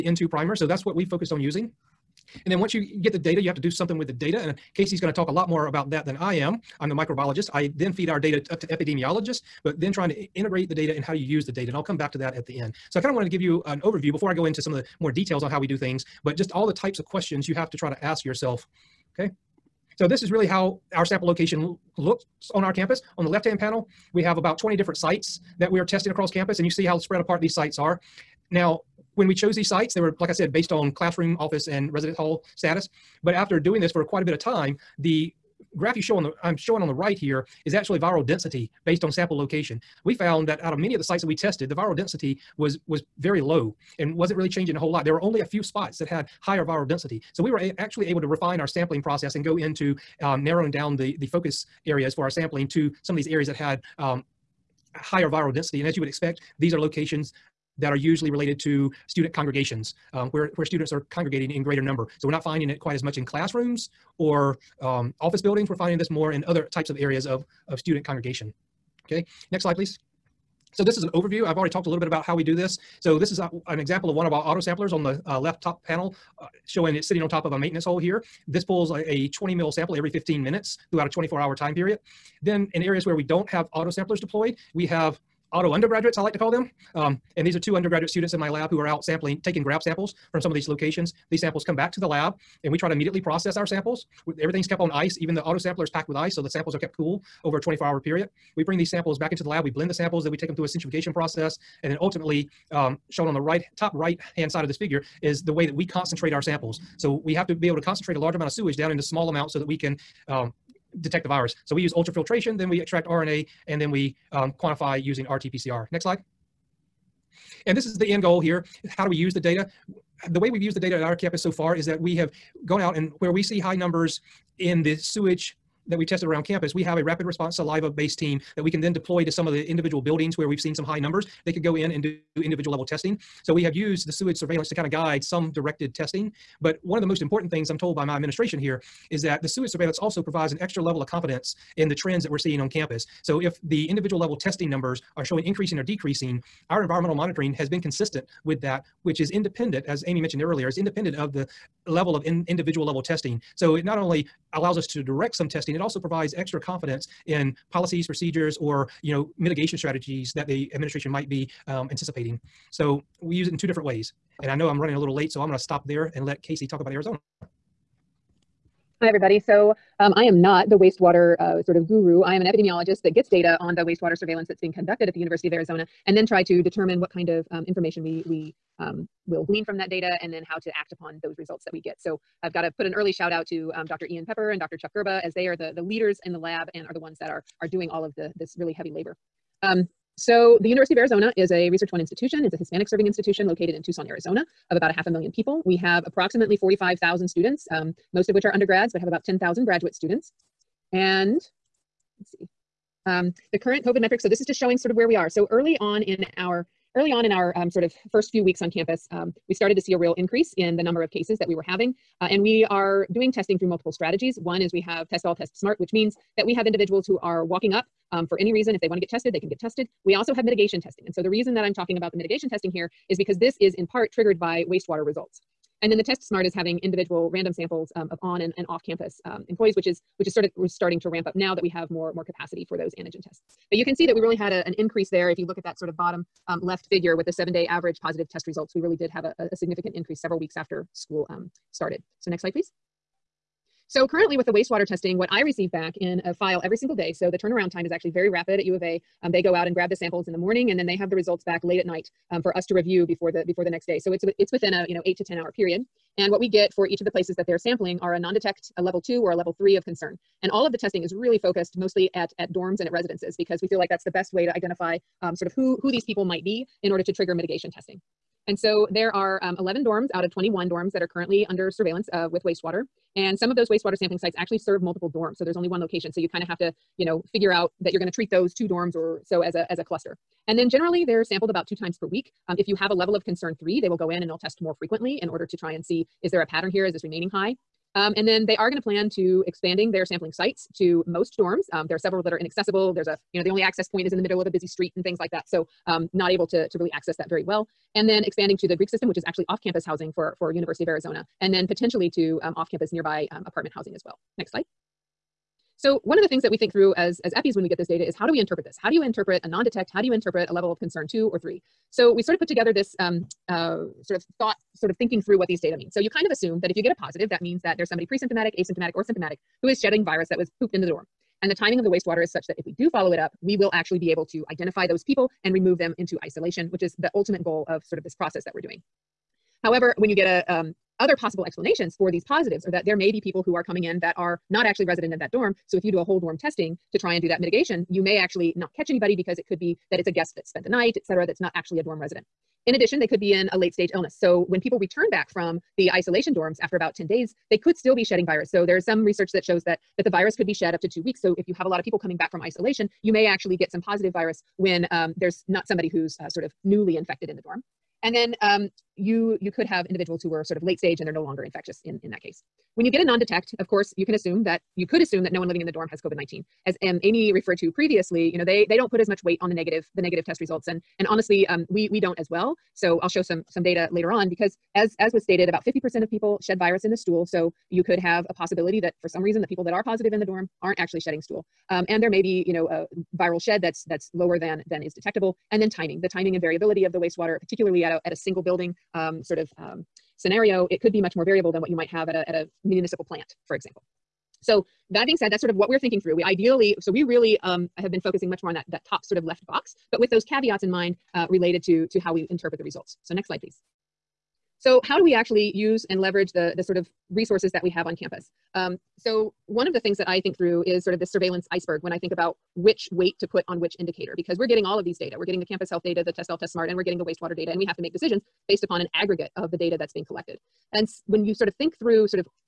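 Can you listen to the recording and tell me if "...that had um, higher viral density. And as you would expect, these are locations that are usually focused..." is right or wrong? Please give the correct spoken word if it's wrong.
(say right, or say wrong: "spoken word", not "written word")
wrong: "related", not "focused".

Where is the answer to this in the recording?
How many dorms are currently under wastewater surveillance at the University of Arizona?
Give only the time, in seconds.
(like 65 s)
269 s.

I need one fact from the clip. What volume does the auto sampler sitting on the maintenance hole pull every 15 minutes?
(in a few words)
20 ml.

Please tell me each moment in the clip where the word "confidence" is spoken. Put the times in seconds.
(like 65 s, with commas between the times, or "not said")
141 s, 156 s.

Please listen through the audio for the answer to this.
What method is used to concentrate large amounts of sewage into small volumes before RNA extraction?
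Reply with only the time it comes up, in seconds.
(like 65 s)
111 s.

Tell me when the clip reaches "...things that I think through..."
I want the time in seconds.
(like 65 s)
409 s.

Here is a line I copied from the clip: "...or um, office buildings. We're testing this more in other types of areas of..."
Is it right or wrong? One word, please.
wrong.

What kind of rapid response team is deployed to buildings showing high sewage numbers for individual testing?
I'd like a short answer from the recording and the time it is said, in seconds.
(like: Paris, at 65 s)
Saliva based team, at 127 s.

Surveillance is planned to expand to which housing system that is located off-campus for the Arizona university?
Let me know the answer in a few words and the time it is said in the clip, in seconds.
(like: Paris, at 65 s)
Greek system, at 298 s.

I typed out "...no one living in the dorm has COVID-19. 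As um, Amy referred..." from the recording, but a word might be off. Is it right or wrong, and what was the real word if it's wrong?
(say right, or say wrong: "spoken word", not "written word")
right.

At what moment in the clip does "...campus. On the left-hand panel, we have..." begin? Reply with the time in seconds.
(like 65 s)
22 s.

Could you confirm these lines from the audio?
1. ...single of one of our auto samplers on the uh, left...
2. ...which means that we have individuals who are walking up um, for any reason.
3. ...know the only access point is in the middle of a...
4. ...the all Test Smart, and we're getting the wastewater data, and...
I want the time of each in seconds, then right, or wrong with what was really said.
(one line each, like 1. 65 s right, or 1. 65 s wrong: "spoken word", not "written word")
1. 73 s wrong: "example", not "single"
2. 215 s right
3. 293 s right
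4. 416 s right.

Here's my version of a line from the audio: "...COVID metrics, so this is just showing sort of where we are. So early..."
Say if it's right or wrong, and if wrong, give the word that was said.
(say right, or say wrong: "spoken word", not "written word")
right.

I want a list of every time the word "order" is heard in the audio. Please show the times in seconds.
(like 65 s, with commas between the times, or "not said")
266 s, 285 s.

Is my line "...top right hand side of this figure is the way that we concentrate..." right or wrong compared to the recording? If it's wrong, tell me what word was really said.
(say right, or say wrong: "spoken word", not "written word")
right.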